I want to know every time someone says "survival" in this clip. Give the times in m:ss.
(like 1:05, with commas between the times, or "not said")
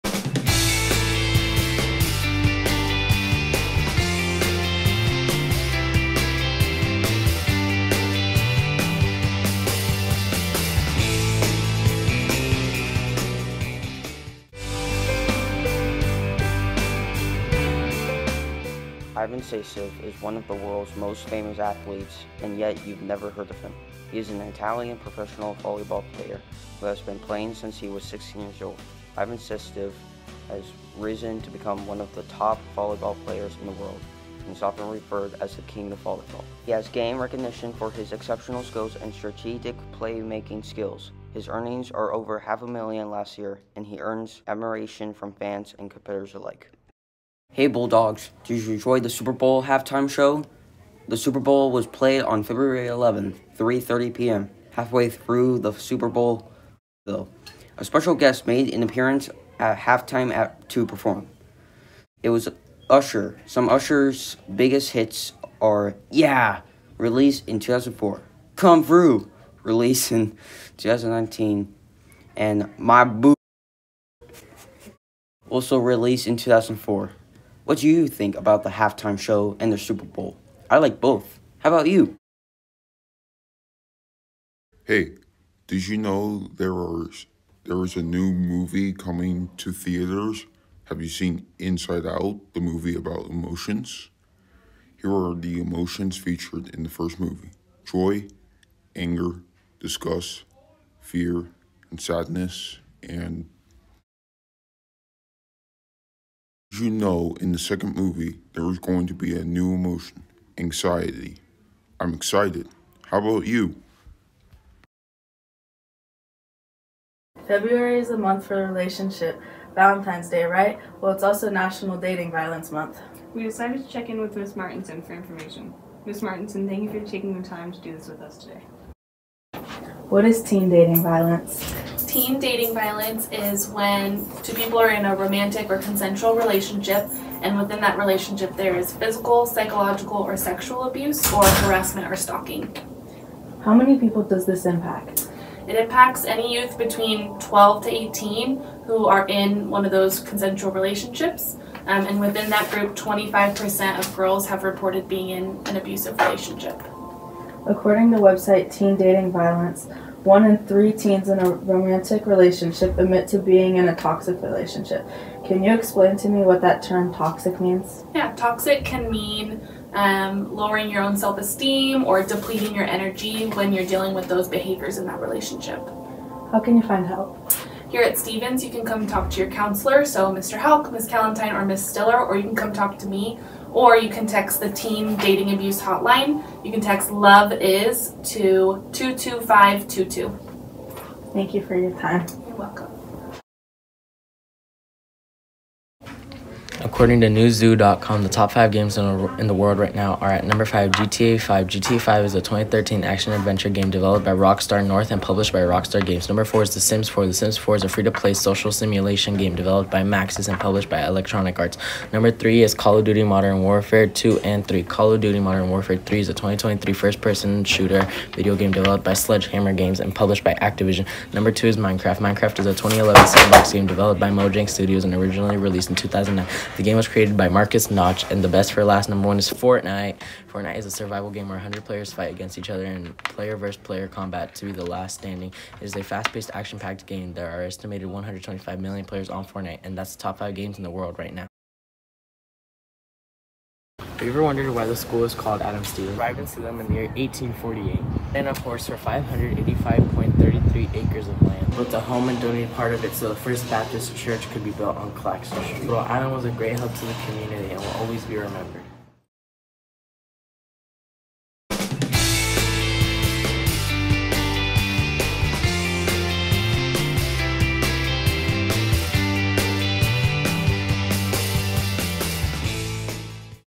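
3:50.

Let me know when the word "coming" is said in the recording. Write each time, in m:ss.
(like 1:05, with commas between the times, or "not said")
1:28.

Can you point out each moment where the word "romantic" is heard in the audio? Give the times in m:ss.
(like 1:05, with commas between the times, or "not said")
2:15, 2:41.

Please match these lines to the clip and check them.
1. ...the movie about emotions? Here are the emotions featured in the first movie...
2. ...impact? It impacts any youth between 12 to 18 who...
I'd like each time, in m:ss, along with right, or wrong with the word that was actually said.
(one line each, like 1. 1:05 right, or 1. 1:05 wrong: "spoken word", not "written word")
1. 1:32 right
2. 2:24 right.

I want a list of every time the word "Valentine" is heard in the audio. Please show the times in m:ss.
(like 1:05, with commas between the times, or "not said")
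1:59.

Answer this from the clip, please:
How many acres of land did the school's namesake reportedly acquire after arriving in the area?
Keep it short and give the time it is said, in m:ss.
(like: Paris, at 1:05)
585.33, at 4:08.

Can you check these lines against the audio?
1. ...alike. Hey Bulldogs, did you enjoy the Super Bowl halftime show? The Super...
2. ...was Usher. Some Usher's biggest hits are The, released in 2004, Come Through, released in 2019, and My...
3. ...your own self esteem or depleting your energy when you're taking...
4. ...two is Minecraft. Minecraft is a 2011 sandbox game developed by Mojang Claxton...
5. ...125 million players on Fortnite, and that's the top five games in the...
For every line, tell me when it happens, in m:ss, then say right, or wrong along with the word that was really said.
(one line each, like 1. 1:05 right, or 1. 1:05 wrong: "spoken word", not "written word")
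1. 0:46 right
2. 1:02 wrong: "Yeah", not "The"
3. 2:50 wrong: "dealing", not "taking"
4. 3:41 wrong: "Studios", not "Claxton"
5. 3:58 right.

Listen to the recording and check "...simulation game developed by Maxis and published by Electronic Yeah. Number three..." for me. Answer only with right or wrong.
wrong.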